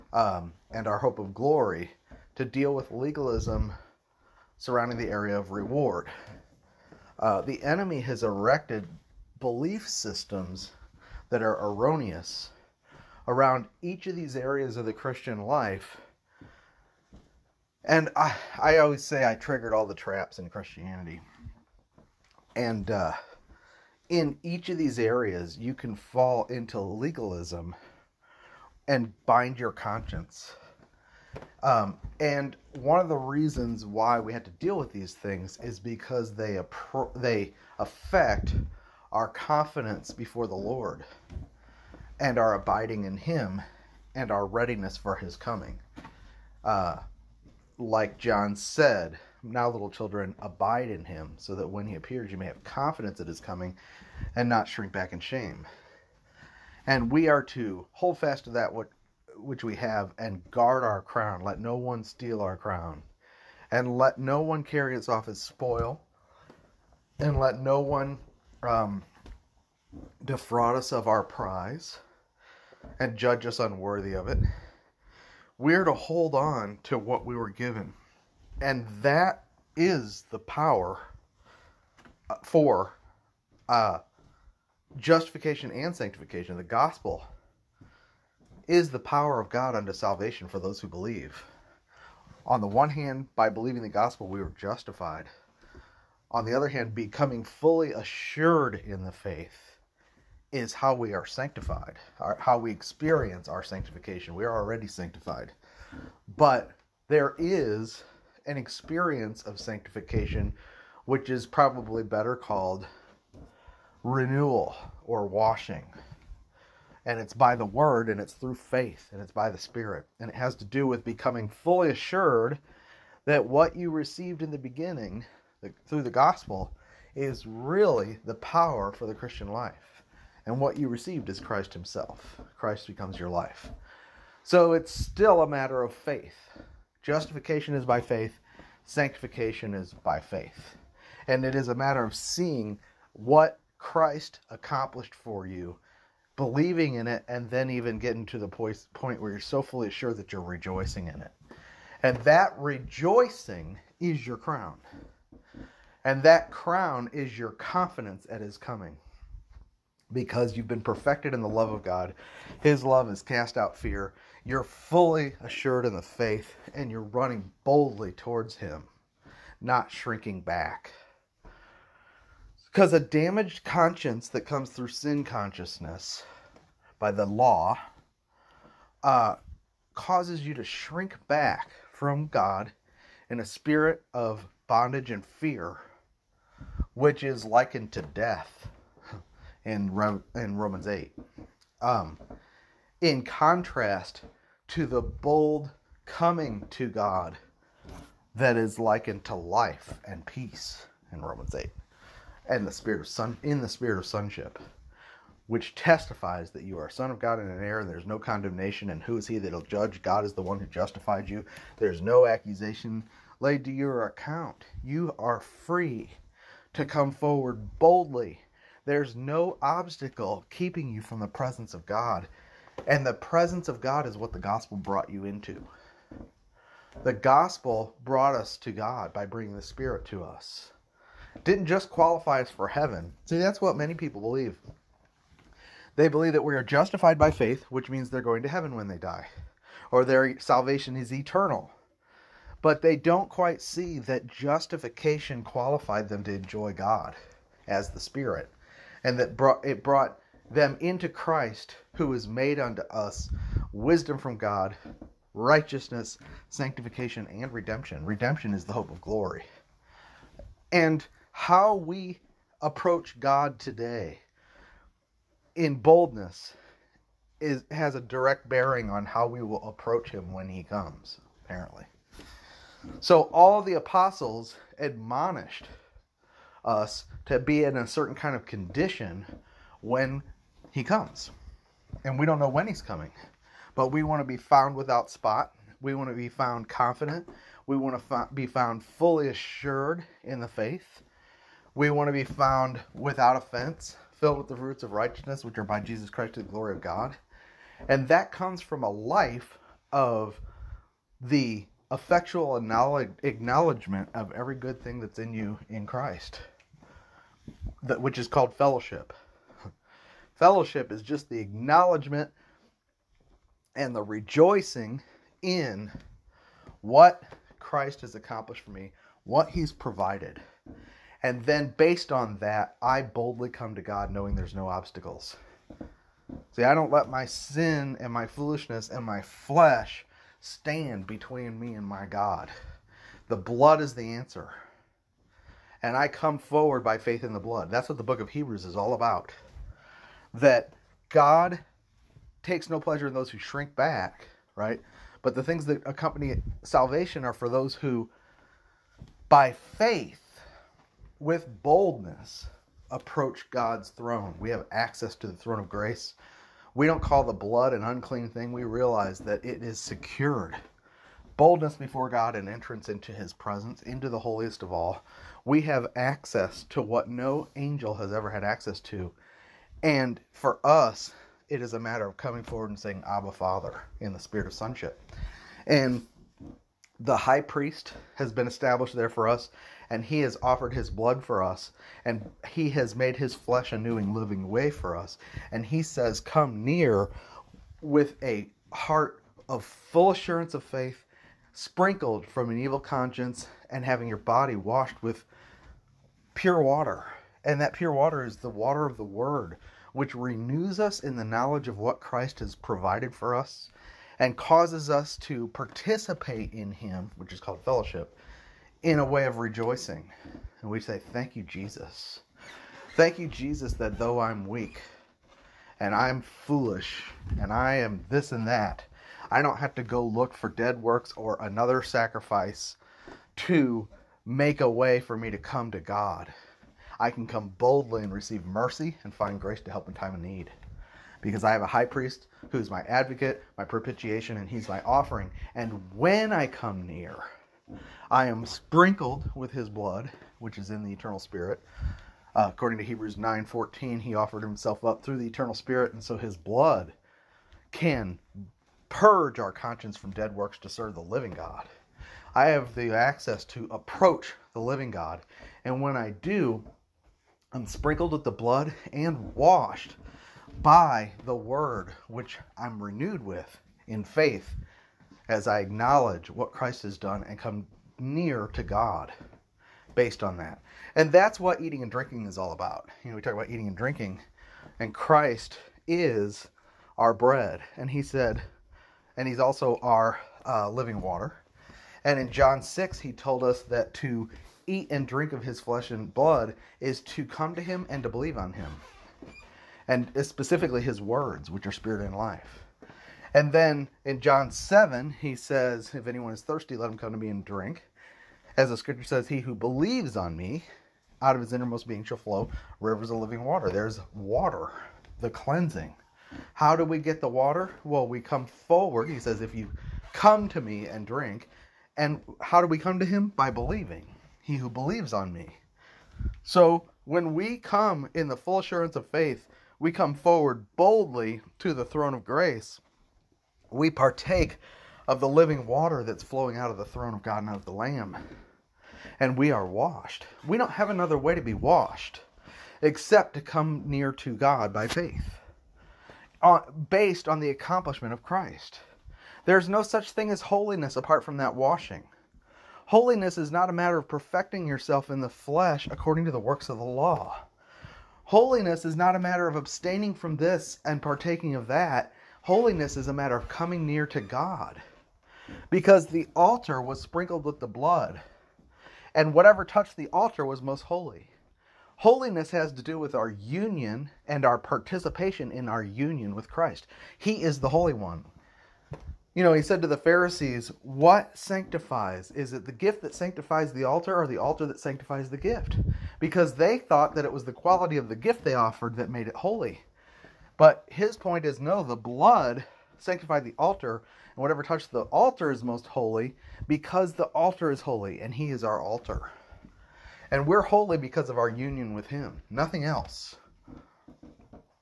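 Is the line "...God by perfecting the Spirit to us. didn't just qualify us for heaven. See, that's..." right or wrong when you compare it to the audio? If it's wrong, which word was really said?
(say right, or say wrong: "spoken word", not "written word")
wrong: "bringing", not "perfecting".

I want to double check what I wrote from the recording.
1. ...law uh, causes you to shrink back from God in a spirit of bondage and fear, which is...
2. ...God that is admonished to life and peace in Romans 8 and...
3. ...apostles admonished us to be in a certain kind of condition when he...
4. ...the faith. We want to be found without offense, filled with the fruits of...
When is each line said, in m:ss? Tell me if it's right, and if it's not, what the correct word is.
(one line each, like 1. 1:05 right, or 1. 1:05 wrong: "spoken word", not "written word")
1. 2:57 right
2. 3:16 wrong: "likened", not "admonished"
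3. 4:33 right
4. 4:50 right.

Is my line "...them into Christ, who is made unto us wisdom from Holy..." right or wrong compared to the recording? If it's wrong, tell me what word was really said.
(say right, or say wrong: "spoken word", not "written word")
wrong: "God", not "Holy".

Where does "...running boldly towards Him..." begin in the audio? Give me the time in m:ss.
2:47.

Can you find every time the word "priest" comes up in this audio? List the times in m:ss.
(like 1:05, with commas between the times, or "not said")
6:17, 7:11.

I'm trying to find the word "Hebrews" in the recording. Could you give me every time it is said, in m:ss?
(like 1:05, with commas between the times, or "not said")
5:38, 7:22.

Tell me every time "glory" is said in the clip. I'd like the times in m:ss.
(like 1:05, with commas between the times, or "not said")
0:01, 4:19, 4:56.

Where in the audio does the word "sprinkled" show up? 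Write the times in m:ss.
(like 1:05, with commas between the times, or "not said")
6:31, 7:18, 7:37, 9:17.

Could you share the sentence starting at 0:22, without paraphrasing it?
And uh, in each of these areas, you can fall into legalism and bind your conscience.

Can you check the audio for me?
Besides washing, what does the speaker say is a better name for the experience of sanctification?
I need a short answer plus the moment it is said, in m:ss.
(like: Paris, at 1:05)
Renewal, at 1:54.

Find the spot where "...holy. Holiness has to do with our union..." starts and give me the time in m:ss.
9:20.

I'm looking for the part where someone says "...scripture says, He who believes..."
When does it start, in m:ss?
8:18.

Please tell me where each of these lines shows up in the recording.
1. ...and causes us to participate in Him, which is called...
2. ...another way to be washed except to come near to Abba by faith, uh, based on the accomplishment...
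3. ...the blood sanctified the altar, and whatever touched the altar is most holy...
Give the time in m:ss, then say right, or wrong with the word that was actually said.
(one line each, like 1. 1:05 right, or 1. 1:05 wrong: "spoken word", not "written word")
1. 6:44 right
2. 8:50 wrong: "God", not "Abba"
3. 9:41 right.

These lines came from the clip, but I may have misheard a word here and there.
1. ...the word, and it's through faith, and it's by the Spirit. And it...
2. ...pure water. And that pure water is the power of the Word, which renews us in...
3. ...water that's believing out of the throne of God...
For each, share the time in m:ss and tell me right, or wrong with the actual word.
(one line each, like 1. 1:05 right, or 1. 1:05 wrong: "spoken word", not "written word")
1. 1:57 right
2. 6:36 wrong: "water", not "power"
3. 8:45 wrong: "flowing", not "believing".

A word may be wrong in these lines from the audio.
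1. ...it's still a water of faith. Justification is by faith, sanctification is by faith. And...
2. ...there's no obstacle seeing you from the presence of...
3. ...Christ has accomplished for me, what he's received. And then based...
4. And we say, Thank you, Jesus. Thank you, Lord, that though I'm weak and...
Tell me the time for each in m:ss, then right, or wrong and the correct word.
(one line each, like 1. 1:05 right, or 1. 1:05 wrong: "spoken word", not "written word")
1. 2:14 wrong: "matter", not "water"
2. 3:38 wrong: "keeping", not "seeing"
3. 5:17 wrong: "provided", not "received"
4. 6:50 wrong: "Jesus", not "Lord".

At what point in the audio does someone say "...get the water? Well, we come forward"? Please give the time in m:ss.
8:26.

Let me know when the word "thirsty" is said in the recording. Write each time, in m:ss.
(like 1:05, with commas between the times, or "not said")
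8:16.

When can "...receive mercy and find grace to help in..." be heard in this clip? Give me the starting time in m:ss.
7:08.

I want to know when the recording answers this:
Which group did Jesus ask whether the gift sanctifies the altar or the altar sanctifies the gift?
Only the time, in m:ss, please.
9:29.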